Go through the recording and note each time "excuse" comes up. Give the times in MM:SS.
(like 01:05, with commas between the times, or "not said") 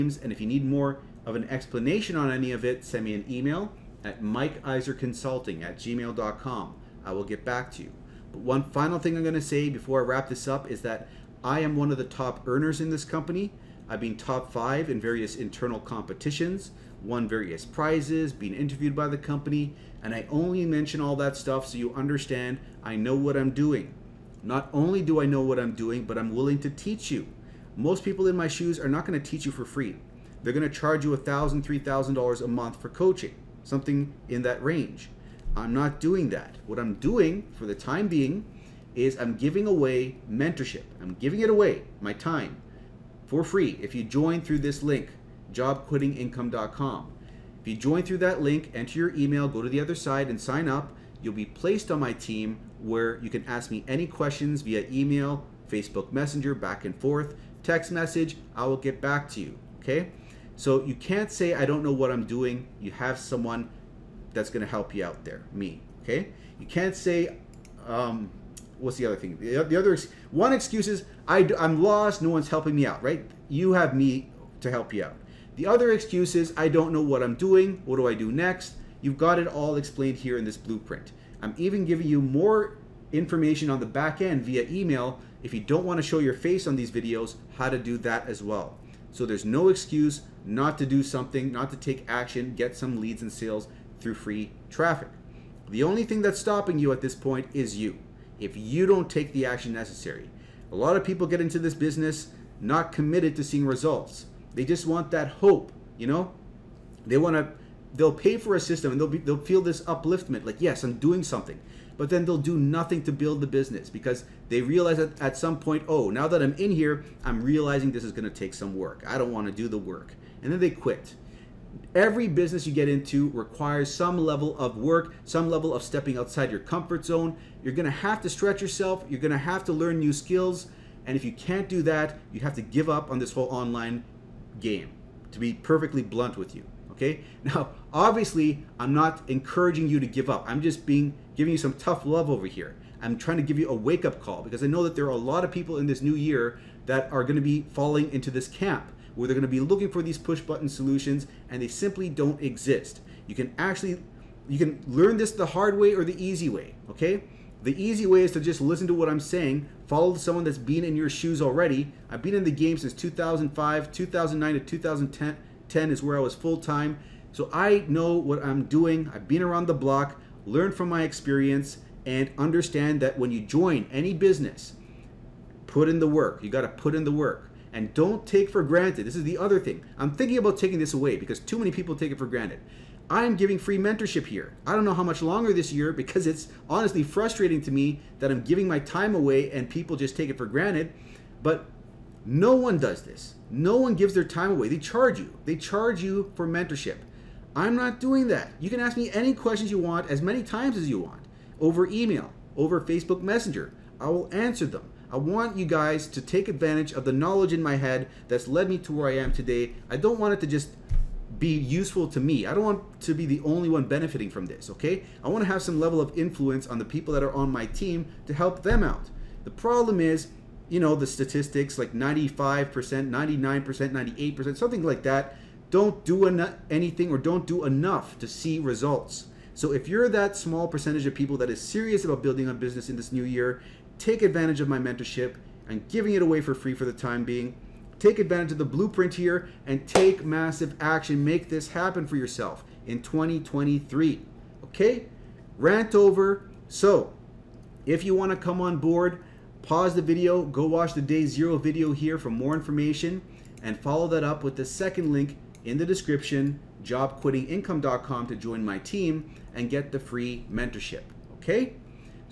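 01:10, 01:15, 01:29.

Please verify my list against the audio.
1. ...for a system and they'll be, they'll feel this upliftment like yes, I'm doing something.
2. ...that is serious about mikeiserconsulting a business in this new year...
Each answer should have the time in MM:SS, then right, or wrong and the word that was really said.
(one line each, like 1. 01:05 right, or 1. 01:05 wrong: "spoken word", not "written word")
1. 01:48 right
2. 03:51 wrong: "building", not "mikeiserconsulting".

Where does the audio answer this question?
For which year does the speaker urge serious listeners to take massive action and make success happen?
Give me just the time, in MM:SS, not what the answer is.
04:03.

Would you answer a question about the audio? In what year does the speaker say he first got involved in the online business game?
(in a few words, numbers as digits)
2005.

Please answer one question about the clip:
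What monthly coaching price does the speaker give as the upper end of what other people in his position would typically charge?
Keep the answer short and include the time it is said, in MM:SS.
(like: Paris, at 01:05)
$3,000, at 00:31.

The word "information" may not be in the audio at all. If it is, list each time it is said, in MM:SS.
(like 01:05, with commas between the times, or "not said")
01:23, 04:12.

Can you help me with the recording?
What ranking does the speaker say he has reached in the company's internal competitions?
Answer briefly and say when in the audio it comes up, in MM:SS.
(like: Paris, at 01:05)
top 5, at 00:14.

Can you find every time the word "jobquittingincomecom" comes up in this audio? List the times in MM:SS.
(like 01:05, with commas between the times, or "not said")
00:45, 04:16.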